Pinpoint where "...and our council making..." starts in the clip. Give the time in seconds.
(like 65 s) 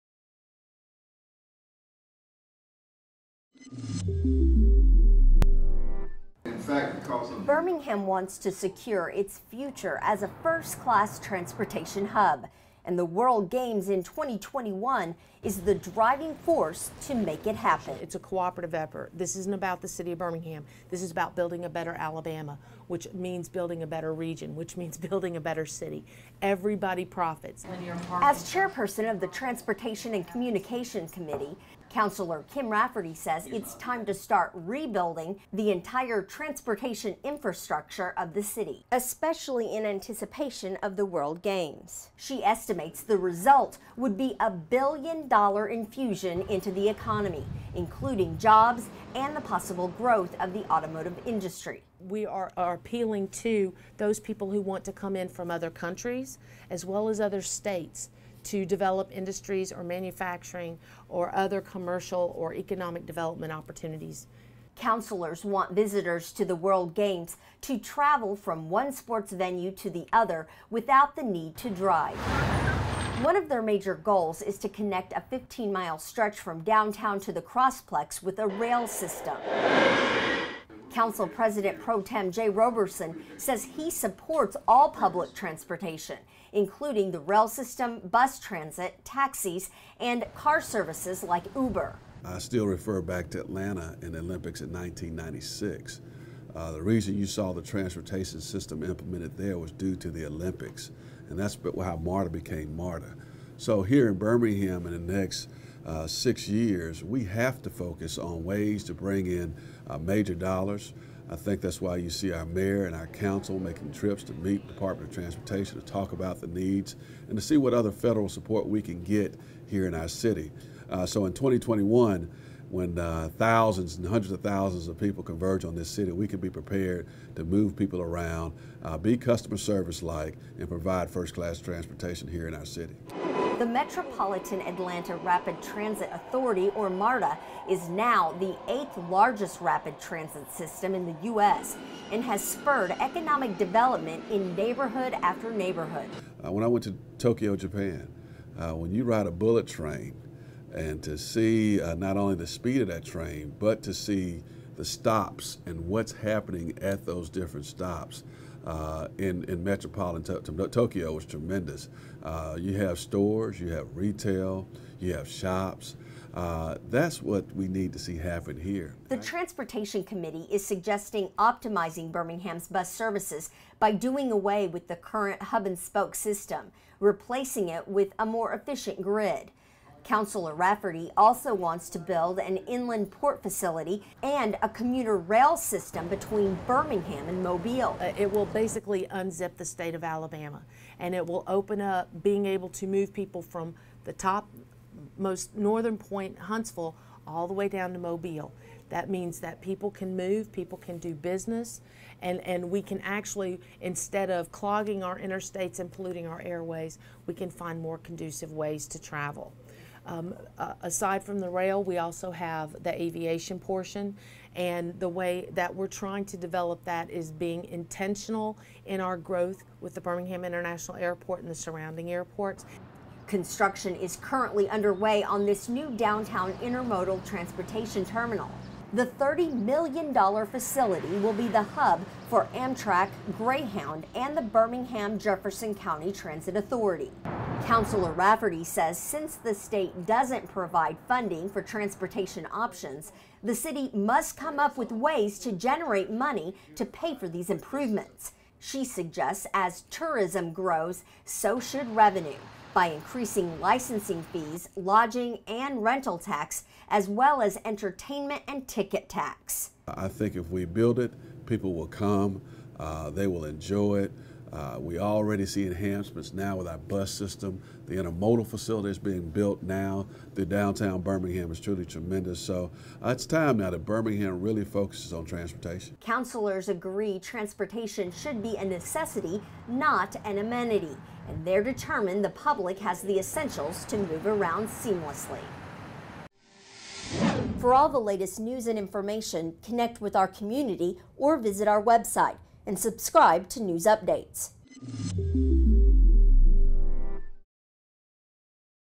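112 s.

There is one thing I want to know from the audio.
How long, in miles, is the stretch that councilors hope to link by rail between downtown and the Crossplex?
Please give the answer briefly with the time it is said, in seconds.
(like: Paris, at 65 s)
15 miles, at 75 s.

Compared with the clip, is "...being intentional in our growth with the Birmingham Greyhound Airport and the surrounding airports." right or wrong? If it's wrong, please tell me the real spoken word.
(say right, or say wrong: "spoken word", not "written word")
wrong: "International", not "Greyhound".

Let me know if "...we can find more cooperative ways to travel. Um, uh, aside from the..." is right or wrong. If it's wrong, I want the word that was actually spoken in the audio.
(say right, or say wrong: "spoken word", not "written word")
wrong: "conducive", not "cooperative".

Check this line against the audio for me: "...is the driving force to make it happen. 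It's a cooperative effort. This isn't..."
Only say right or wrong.
right.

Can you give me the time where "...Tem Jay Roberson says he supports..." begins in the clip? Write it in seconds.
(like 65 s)
82 s.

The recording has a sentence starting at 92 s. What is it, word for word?
I still refer back to Atlanta and the Olympics in 1996.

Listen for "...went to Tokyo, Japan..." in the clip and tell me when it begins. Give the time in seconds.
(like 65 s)
146 s.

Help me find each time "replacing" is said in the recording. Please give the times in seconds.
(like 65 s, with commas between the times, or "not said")
176 s.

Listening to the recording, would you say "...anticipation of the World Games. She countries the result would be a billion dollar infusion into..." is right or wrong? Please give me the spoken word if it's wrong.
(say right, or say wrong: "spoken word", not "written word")
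wrong: "estimates", not "countries".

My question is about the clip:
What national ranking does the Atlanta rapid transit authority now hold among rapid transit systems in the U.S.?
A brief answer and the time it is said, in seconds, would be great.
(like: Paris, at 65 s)
eighth largest, at 138 s.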